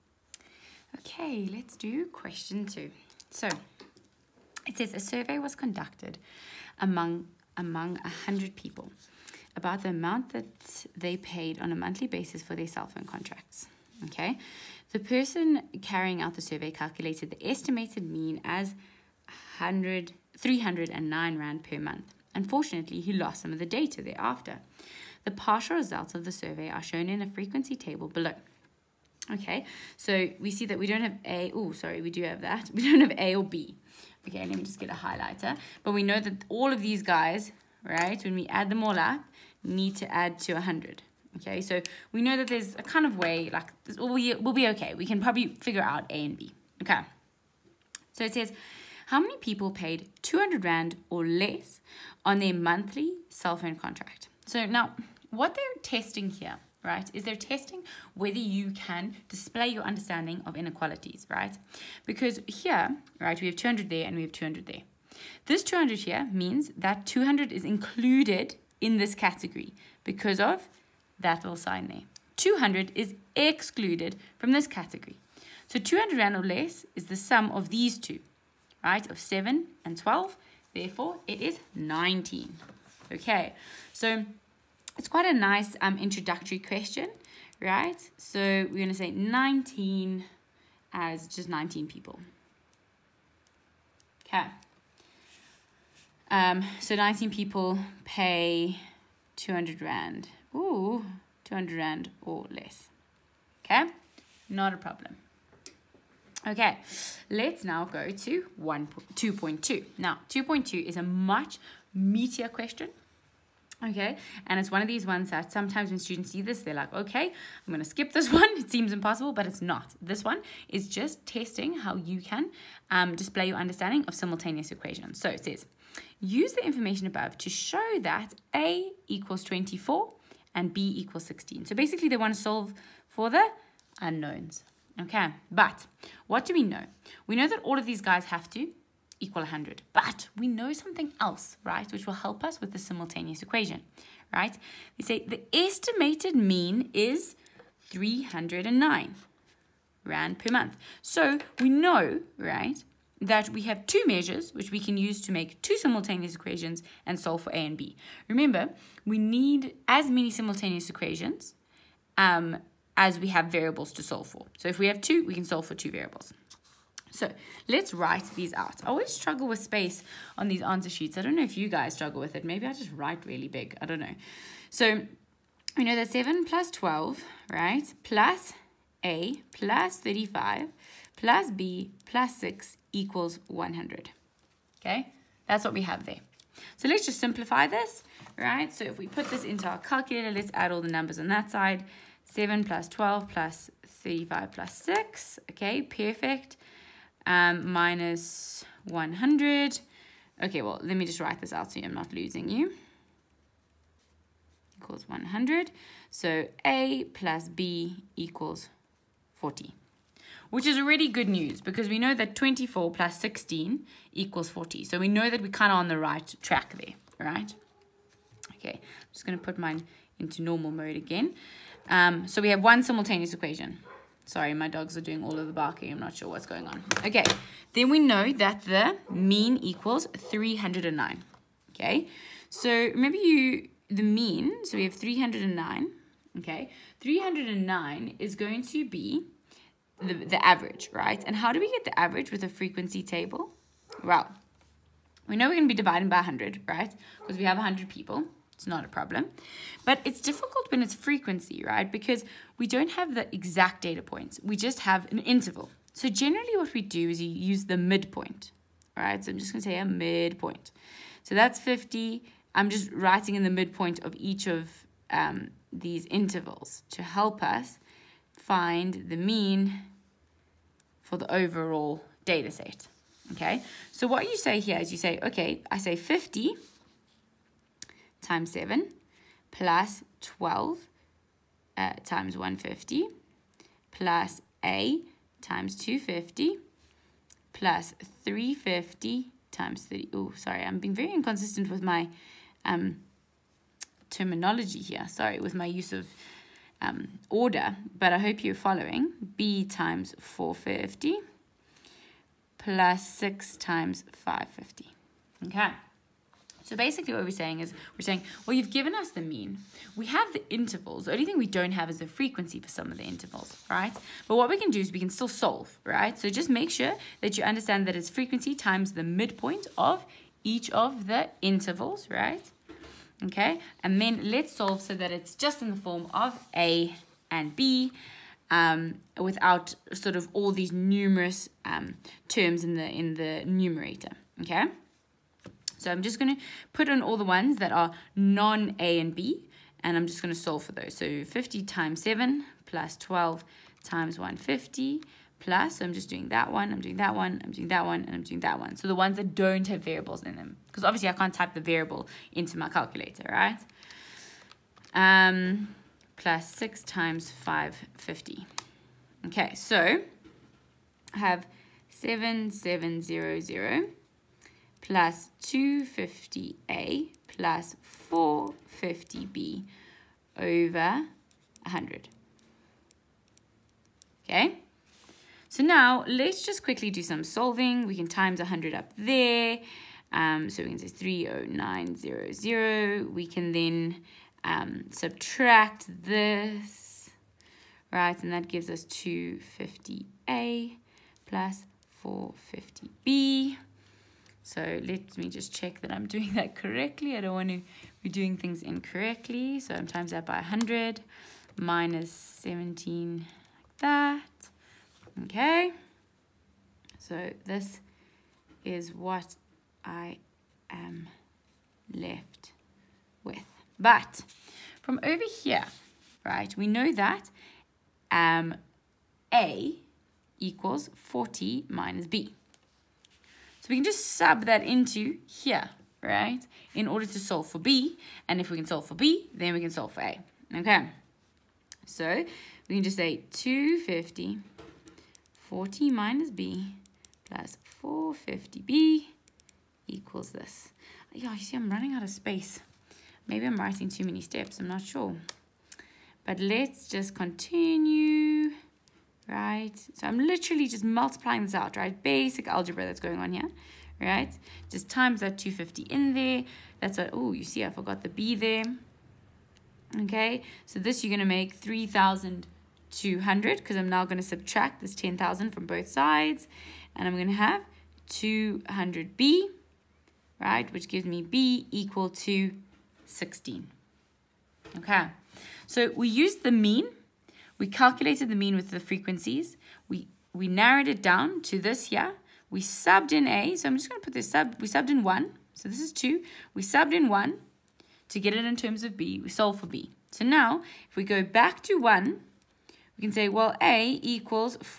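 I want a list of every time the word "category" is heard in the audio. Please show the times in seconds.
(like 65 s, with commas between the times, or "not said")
69 s, 74 s.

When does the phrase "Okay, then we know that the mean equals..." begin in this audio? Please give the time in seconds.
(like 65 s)
227 s.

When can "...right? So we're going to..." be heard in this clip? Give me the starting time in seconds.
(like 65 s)
87 s.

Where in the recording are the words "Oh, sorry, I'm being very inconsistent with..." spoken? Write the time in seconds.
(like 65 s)
290 s.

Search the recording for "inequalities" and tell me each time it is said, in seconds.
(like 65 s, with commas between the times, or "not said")
60 s.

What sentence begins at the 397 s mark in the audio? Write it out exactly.
I don't want to be doing things incorrectly.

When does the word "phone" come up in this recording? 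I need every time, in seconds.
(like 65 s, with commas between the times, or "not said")
12 s, 53 s.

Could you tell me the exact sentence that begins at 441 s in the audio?
Yeah, you see I'm running out of space.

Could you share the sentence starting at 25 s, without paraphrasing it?
The partial results of the survey are shown in a frequency table below.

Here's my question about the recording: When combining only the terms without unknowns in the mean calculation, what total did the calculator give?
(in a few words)
7700.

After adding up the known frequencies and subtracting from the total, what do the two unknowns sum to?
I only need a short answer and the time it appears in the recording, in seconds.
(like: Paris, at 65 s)
40, at 206 s.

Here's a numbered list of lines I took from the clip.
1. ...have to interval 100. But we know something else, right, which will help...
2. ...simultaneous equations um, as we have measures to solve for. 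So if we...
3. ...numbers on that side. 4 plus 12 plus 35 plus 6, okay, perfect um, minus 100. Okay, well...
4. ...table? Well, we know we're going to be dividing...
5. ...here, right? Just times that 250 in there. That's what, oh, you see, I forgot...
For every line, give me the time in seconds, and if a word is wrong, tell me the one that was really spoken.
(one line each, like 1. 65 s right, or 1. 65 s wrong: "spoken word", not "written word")
1. 138 s wrong: "equal", not "interval"
2. 160 s wrong: "variables", not "measures"
3. 190 s wrong: "7", not "4"
4. 243 s right
5. 453 s right.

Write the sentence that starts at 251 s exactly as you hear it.
Because we don't have the exact data points.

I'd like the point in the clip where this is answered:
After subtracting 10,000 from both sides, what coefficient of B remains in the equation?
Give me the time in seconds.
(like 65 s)
468 s.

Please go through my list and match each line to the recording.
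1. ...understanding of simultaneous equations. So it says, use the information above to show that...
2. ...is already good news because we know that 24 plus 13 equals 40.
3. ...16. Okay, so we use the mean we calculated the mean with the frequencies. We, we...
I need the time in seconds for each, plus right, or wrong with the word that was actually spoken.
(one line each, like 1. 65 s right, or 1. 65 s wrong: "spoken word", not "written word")
1. 123 s right
2. 210 s wrong: "16", not "13"
3. 473 s right.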